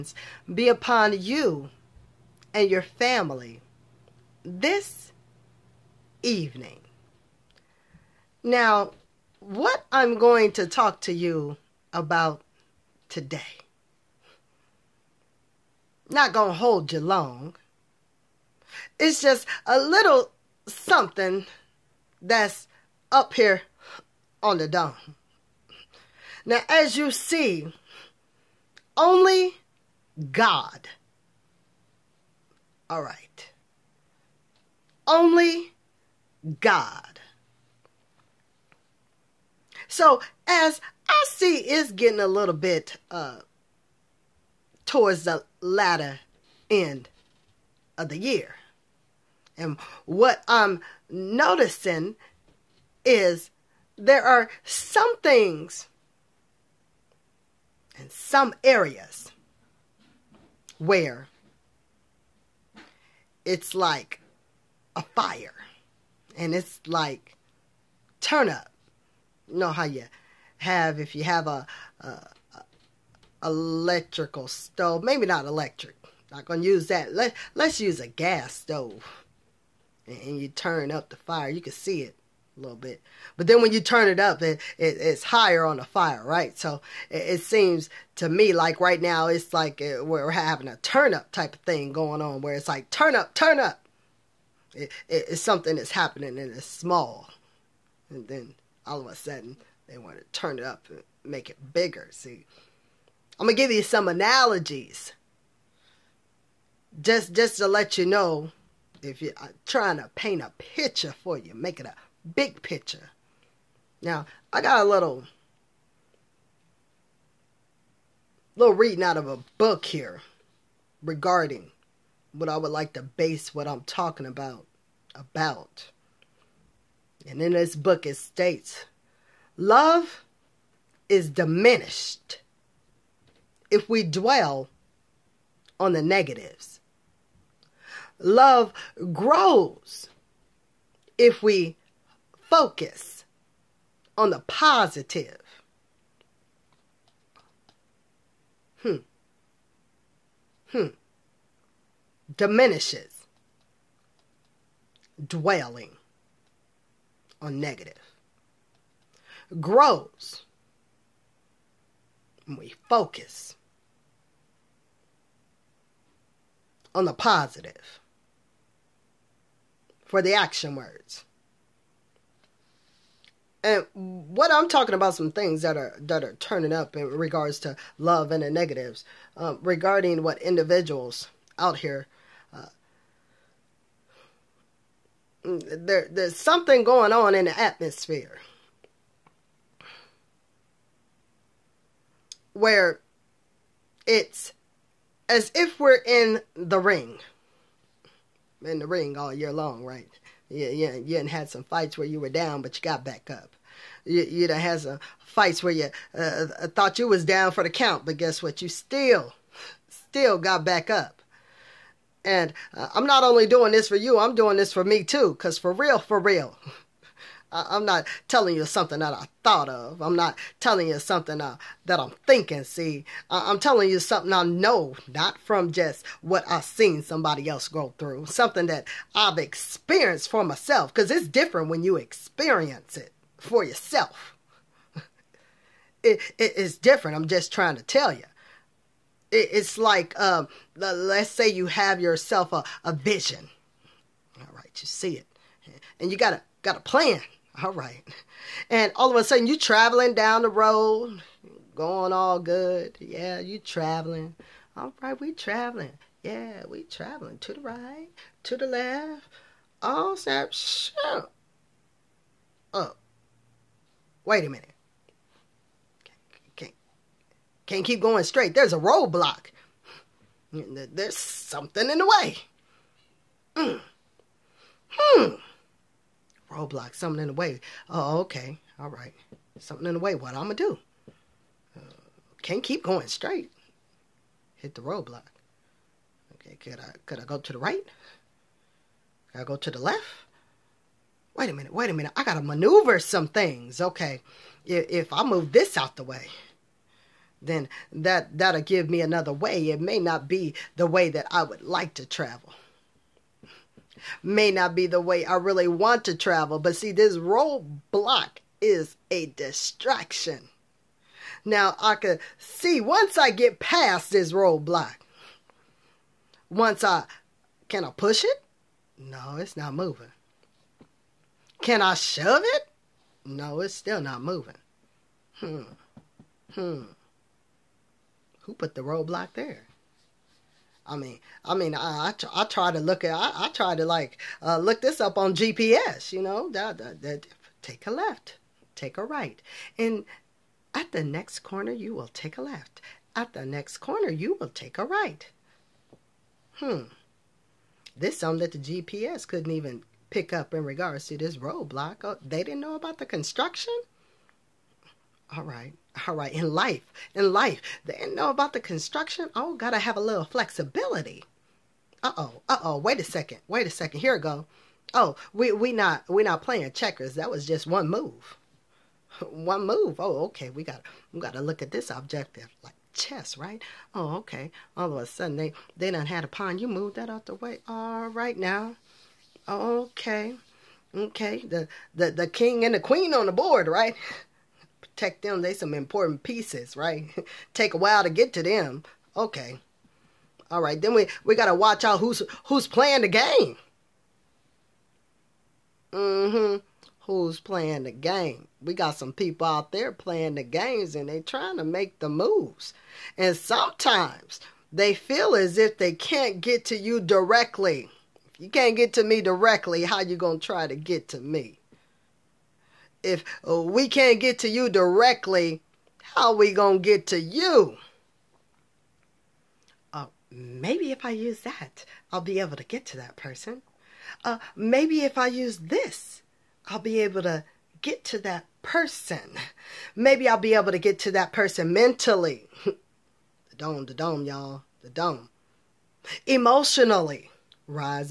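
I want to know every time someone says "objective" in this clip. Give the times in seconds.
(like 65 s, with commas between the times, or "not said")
371 s.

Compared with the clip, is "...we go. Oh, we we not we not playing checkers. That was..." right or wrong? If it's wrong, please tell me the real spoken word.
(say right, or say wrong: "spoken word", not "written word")
right.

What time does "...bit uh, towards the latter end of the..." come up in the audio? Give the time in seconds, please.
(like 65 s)
42 s.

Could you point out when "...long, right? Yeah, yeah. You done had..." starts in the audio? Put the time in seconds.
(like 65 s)
199 s.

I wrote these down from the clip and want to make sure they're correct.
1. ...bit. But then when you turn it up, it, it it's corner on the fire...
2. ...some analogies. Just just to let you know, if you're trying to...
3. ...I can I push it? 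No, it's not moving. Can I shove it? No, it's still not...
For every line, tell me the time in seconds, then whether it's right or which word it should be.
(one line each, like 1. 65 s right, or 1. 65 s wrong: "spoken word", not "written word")
1. 82 s wrong: "higher", not "corner"
2. 103 s right
3. 316 s right.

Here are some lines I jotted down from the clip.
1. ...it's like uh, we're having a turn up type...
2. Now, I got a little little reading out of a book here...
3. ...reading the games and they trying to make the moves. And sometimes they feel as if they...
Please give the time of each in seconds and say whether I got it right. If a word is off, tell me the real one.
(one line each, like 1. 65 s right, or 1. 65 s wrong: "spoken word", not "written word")
1. 89 s right
2. 114 s right
3. 399 s wrong: "playing", not "reading".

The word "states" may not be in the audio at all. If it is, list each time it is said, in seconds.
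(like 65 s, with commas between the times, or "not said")
128 s.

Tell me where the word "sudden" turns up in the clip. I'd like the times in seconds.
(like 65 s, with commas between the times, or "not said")
99 s, 249 s, 375 s.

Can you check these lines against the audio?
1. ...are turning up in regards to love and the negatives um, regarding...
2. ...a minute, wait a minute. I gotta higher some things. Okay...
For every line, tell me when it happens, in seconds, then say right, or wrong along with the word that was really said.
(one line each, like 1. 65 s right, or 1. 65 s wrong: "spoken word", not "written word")
1. 176 s right
2. 291 s wrong: "maneuver", not "higher".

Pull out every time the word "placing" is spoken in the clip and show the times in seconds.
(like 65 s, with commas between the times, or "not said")
not said.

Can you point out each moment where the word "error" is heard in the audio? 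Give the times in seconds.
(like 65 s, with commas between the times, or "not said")
not said.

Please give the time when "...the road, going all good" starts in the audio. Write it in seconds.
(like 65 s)
250 s.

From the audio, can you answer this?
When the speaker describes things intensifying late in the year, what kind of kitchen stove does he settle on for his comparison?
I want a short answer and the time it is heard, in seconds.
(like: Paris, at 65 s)
gas stove, at 78 s.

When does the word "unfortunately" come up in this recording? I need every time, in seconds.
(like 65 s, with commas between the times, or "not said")
not said.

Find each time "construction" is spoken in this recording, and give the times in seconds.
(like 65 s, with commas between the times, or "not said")
353 s, 358 s.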